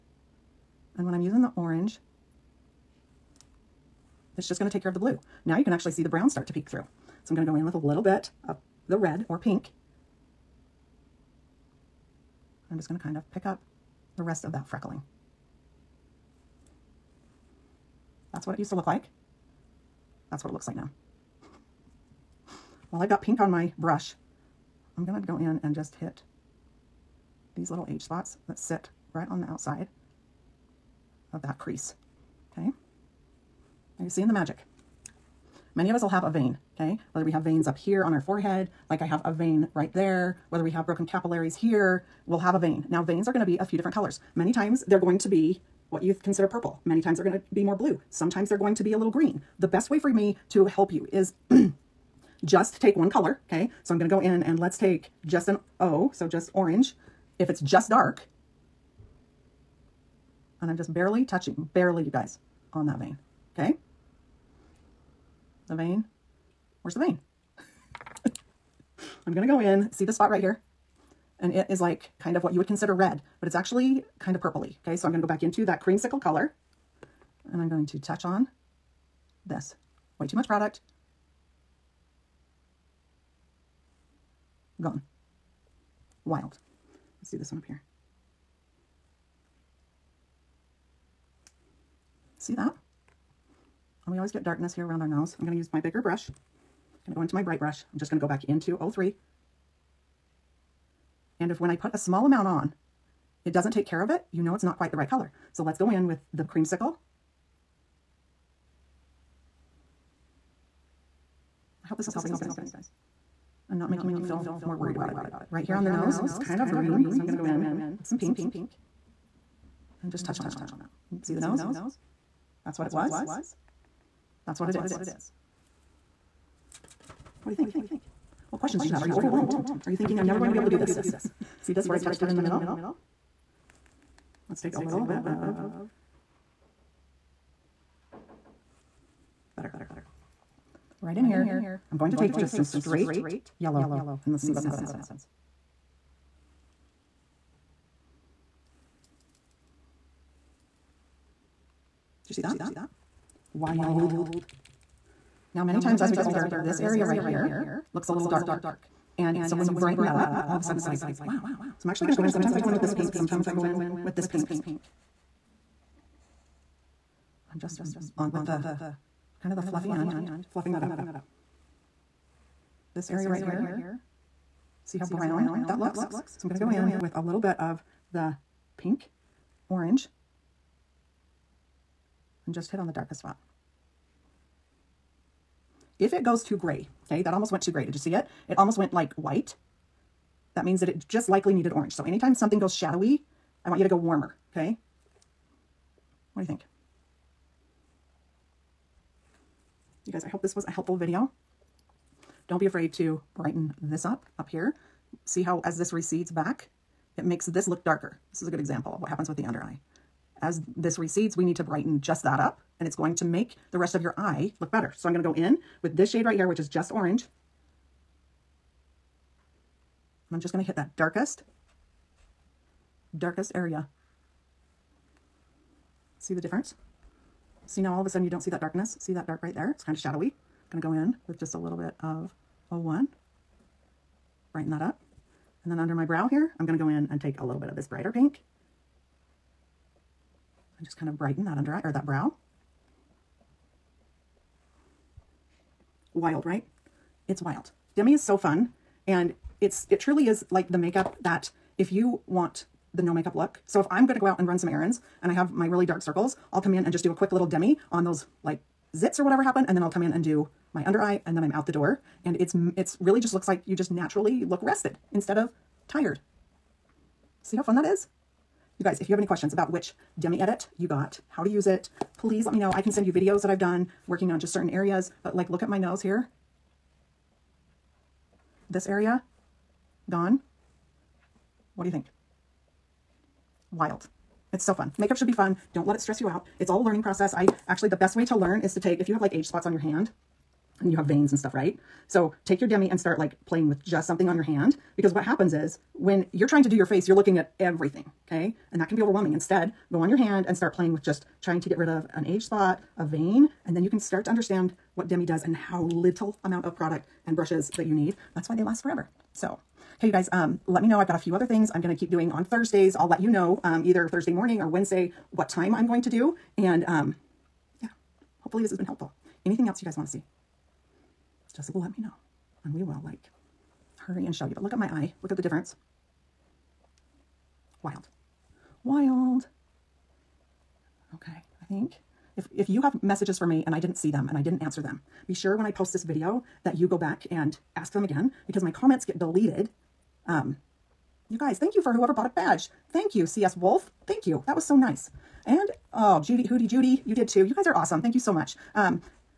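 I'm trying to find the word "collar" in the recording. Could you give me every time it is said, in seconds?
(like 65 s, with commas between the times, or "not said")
not said.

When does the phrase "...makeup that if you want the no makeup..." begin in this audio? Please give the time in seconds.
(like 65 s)
250 s.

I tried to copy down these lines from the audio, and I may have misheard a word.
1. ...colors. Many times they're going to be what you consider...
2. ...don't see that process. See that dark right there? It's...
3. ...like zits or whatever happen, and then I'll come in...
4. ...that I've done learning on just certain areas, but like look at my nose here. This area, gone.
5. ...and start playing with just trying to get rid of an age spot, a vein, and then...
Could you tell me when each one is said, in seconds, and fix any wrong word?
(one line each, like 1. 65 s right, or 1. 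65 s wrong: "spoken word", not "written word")
1. 43 s right
2. 228 s wrong: "darkness", not "process"
3. 258 s right
4. 273 s wrong: "working", not "learning"
5. 300 s right.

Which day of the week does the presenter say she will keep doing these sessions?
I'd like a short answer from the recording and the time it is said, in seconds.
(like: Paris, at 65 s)
Thursday, at 312 s.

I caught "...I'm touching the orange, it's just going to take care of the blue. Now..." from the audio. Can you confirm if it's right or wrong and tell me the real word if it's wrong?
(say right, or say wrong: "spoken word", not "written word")
wrong: "using", not "touching".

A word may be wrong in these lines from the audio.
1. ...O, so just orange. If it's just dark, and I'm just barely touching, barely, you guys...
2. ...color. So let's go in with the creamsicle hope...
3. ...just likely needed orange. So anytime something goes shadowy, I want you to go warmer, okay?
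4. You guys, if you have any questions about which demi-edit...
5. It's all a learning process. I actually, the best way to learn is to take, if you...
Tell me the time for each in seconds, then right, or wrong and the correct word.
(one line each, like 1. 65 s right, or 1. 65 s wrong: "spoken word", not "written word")
1. 55 s right
2. 105 s right
3. 191 s right
4. 268 s right
5. 286 s right.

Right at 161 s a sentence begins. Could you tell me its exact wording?
So I'm actually going to go in.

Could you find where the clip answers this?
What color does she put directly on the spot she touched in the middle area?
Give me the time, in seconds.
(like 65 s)
142 s.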